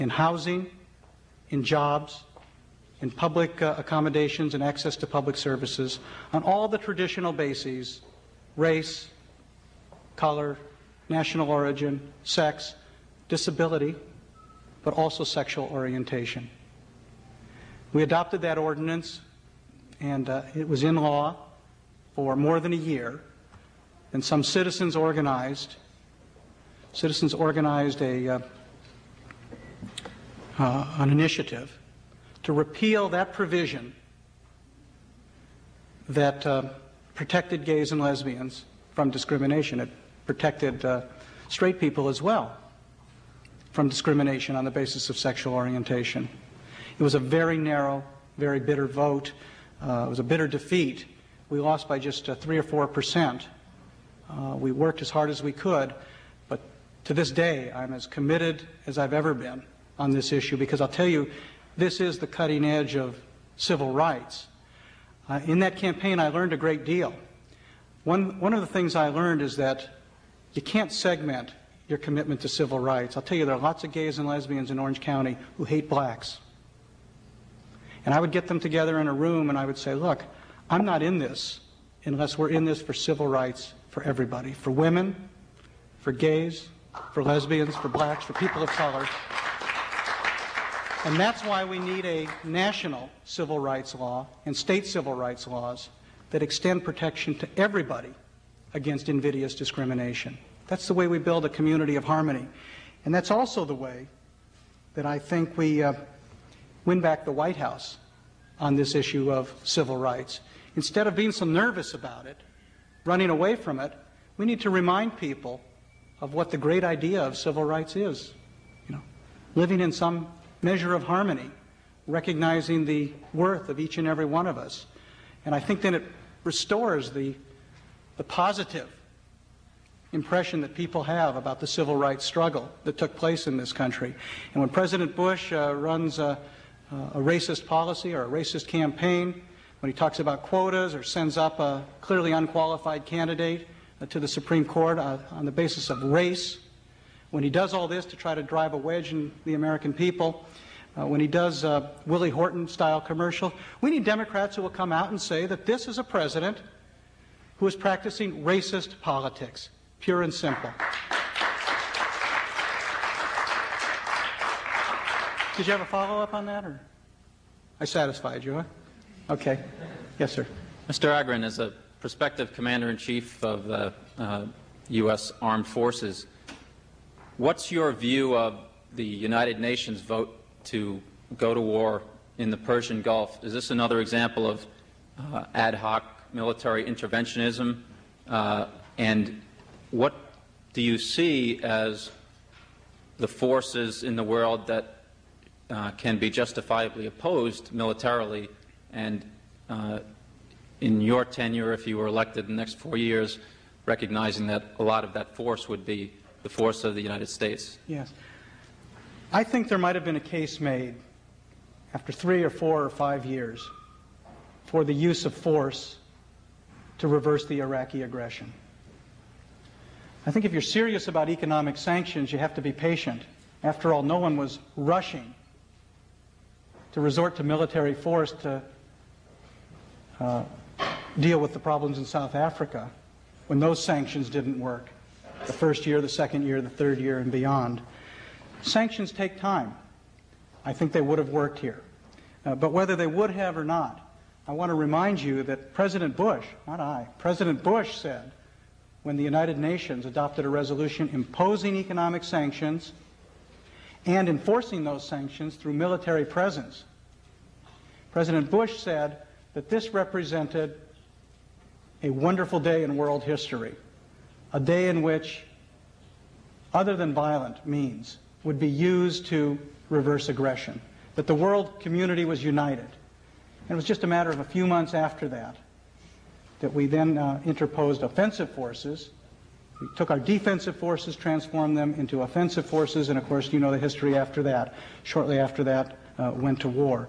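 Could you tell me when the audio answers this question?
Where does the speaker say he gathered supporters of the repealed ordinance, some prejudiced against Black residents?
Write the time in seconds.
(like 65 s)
74 s.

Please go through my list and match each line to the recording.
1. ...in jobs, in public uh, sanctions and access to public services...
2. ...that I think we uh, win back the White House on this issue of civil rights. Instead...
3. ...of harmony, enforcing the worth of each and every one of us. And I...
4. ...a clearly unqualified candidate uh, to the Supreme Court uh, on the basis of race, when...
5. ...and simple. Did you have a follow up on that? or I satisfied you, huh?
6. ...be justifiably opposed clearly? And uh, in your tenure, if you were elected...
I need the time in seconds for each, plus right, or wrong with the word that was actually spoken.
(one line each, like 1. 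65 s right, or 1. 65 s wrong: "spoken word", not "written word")
1. 1 s wrong: "accommodations", not "sanctions"
2. 104 s right
3. 120 s wrong: "recognizing", not "enforcing"
4. 141 s right
5. 160 s right
6. 196 s wrong: "militarily", not "clearly".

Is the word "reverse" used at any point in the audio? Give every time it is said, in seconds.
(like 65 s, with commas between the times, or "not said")
217 s, 269 s.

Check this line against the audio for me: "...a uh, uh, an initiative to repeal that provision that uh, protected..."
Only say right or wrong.
right.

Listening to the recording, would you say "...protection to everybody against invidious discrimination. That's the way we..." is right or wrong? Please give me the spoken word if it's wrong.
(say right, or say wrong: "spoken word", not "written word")
right.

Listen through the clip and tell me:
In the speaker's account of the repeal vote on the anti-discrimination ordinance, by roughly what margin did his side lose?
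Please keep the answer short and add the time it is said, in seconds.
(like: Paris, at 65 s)
3 or 4 percent, at 52 s.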